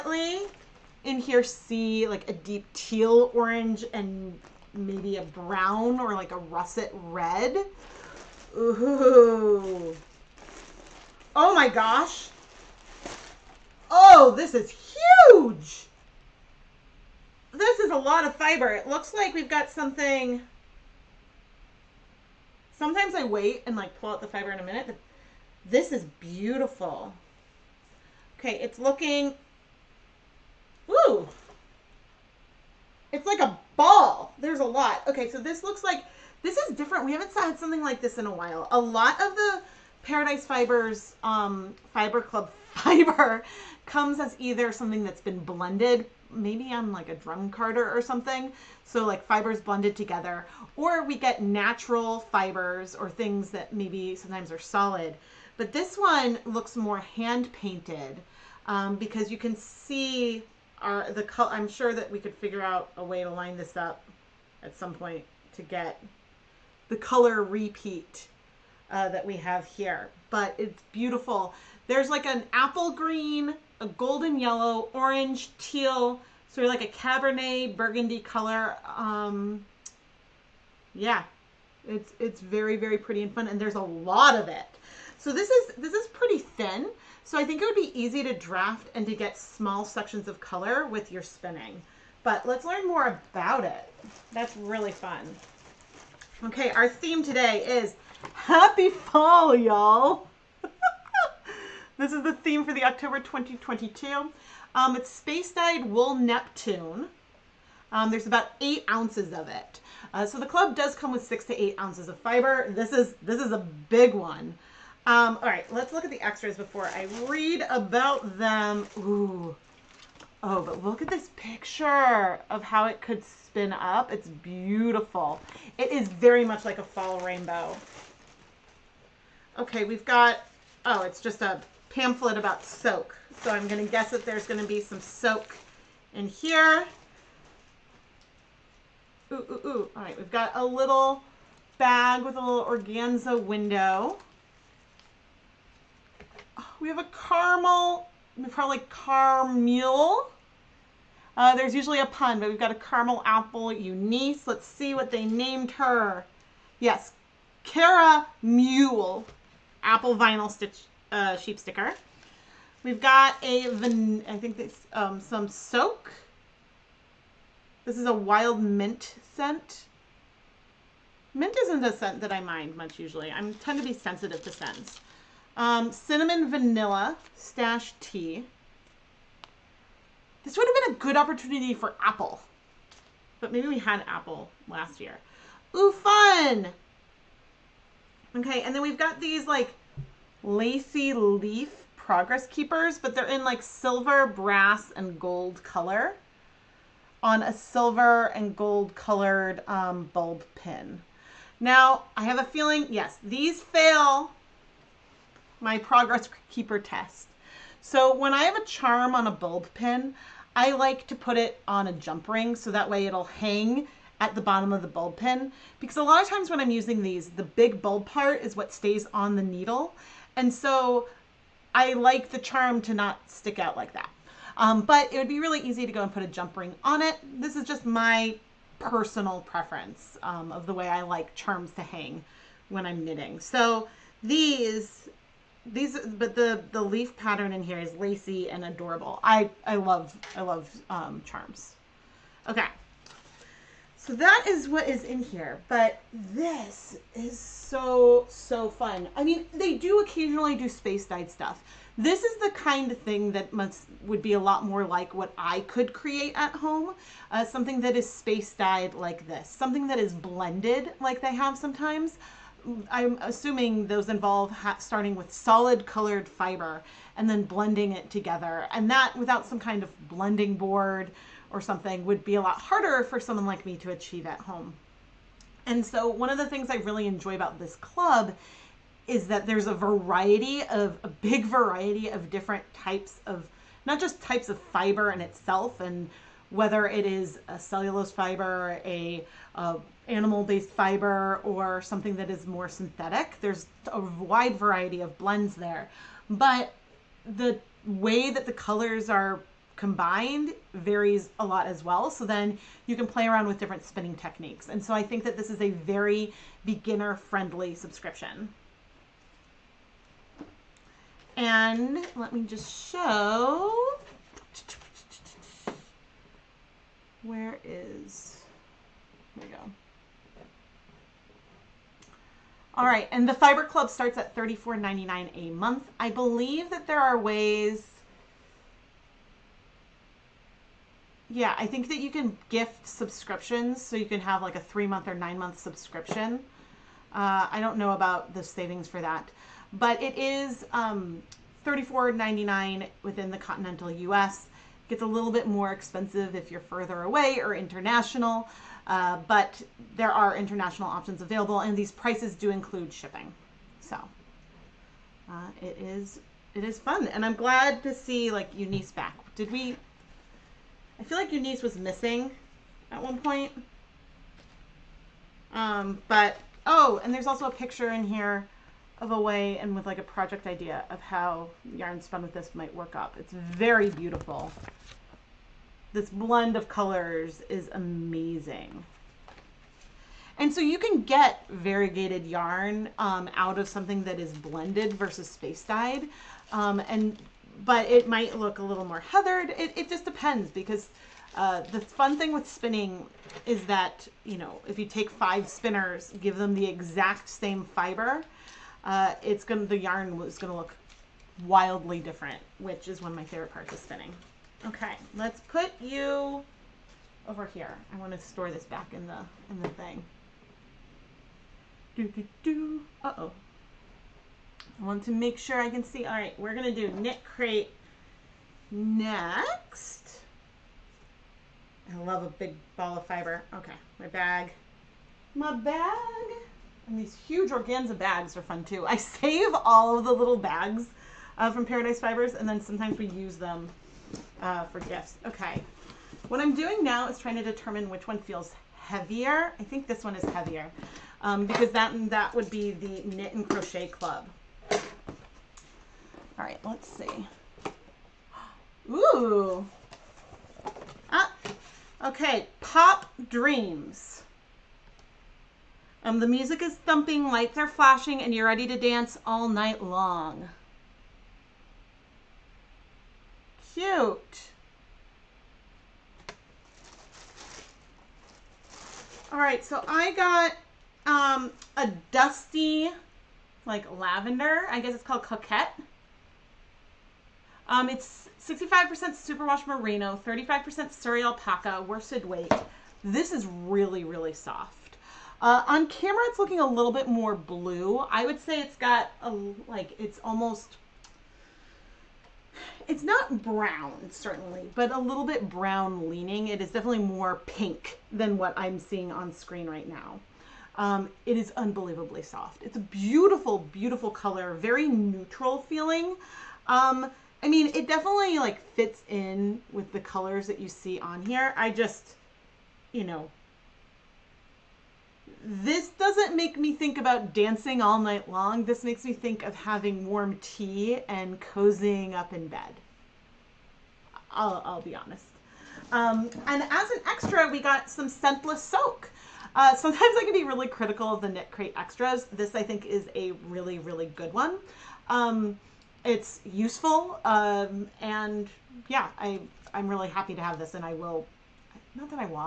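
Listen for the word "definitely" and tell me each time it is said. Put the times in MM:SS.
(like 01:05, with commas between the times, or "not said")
08:16, 08:27.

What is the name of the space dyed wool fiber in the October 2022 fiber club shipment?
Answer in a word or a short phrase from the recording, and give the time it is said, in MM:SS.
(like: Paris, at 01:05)
Neptune, at 01:46.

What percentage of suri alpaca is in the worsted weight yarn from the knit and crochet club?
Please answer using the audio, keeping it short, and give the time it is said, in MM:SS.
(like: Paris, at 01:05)
35%, at 08:00.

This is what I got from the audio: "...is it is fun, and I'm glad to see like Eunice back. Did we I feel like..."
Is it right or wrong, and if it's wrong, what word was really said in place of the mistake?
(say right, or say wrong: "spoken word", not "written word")
right.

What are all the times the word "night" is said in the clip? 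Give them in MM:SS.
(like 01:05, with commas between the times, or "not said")
07:39, 08:37.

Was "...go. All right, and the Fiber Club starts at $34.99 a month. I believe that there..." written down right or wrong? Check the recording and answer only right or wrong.
right.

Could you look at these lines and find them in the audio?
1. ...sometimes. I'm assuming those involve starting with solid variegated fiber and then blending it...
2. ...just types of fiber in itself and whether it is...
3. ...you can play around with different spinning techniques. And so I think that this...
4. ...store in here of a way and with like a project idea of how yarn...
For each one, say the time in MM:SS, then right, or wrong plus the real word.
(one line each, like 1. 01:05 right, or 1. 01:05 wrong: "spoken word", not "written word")
1. 04:21 wrong: "colored", not "variegated"
2. 04:43 right
3. 05:02 right
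4. 06:07 wrong: "picture", not "store".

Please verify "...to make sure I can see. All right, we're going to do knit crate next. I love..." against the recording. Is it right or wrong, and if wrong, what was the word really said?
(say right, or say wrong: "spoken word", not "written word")
right.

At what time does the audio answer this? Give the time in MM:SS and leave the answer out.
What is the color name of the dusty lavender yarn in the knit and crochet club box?
07:55.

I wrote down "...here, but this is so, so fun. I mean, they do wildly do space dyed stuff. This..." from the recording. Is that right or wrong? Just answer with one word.
wrong.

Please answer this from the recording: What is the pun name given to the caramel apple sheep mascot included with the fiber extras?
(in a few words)
Cara Mule.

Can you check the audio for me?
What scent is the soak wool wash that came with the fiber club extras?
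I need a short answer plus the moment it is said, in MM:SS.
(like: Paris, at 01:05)
Wild mint, at 02:48.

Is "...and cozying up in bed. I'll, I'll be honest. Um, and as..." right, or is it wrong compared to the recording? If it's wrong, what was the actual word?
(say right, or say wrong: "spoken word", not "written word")
right.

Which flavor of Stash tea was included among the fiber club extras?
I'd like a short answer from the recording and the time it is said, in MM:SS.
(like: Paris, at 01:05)
Cinnamon vanilla, at 02:55.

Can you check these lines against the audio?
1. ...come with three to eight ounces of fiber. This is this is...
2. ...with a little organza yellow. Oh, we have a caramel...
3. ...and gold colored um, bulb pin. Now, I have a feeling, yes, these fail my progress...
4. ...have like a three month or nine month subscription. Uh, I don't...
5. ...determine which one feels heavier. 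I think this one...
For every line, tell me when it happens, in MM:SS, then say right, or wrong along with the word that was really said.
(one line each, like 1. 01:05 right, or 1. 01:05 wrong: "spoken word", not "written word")
1. 01:50 wrong: "six", not "three"
2. 02:22 wrong: "window", not "yellow"
3. 03:18 right
4. 05:34 right
5. 07:17 right.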